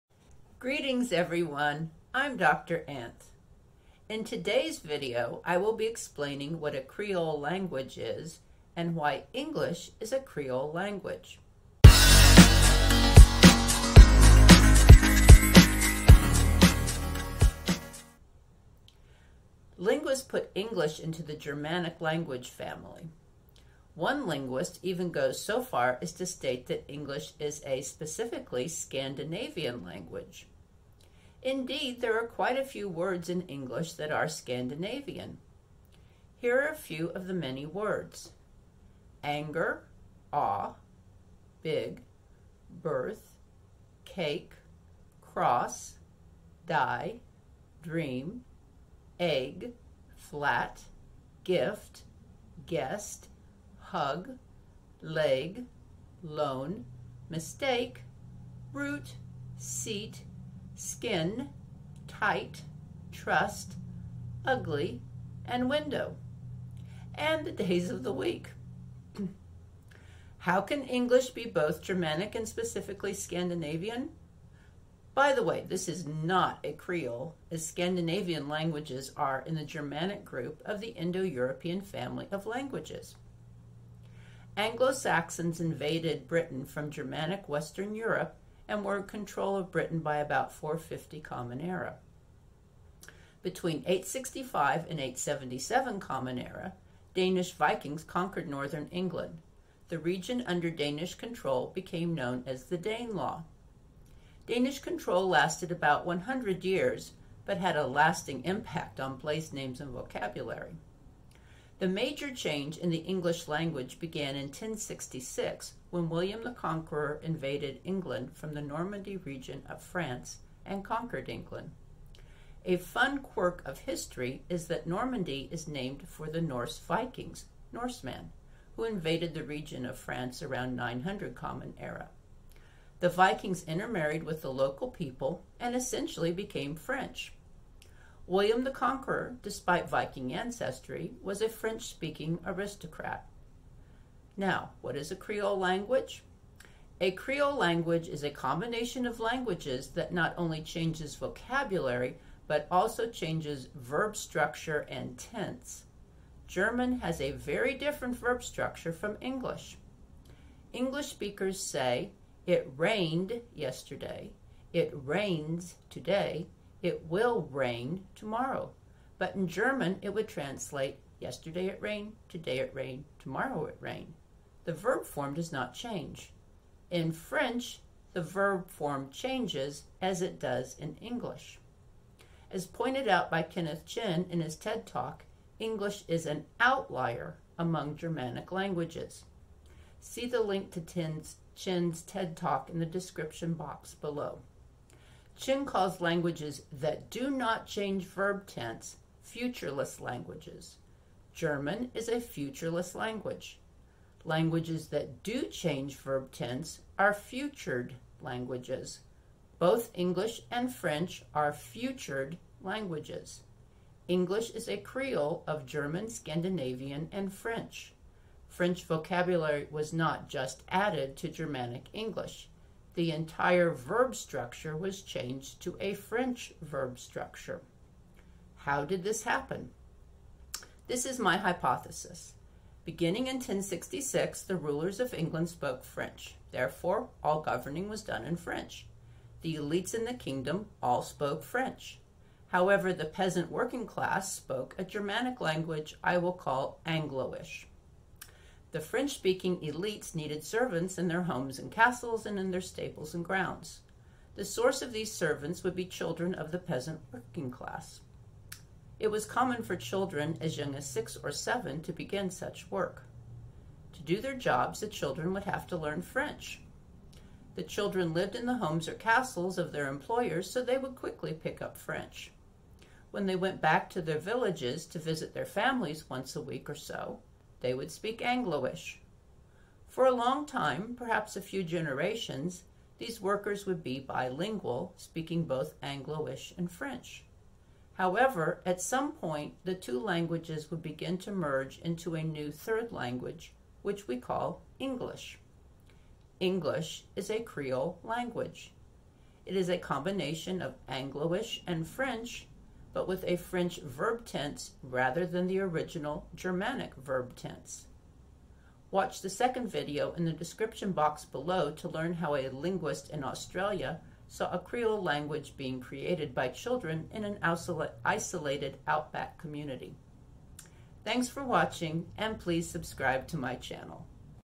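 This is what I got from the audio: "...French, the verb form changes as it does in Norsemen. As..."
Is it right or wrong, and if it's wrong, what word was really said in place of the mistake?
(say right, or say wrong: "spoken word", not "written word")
wrong: "English", not "Norsemen".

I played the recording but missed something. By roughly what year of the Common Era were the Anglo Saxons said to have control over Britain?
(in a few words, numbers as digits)
450.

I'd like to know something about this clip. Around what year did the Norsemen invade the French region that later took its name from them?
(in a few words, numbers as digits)
900.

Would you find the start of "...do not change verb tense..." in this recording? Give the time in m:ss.
3:17.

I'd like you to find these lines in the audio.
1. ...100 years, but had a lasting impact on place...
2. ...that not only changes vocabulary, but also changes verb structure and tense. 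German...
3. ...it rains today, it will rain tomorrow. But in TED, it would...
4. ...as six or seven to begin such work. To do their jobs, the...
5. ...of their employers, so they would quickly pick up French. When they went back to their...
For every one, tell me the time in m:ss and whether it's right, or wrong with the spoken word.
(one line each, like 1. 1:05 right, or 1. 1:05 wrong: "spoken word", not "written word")
1. 1:46 right
2. 2:29 right
3. 2:44 wrong: "German", not "TED"
4. 4:20 right
5. 4:29 right.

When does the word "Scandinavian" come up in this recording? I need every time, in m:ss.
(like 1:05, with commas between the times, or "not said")
0:28, 0:34, 1:13, 1:17, 3:36.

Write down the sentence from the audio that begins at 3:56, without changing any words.
Therefore, all governing was done in French.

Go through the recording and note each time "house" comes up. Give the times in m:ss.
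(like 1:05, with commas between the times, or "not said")
not said.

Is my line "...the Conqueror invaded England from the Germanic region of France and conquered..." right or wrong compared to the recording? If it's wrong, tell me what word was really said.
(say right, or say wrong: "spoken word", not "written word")
wrong: "Normandy", not "Germanic".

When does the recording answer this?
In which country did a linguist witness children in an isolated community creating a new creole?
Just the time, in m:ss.
5:13.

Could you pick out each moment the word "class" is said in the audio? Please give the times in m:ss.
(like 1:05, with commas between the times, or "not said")
4:03, 4:17.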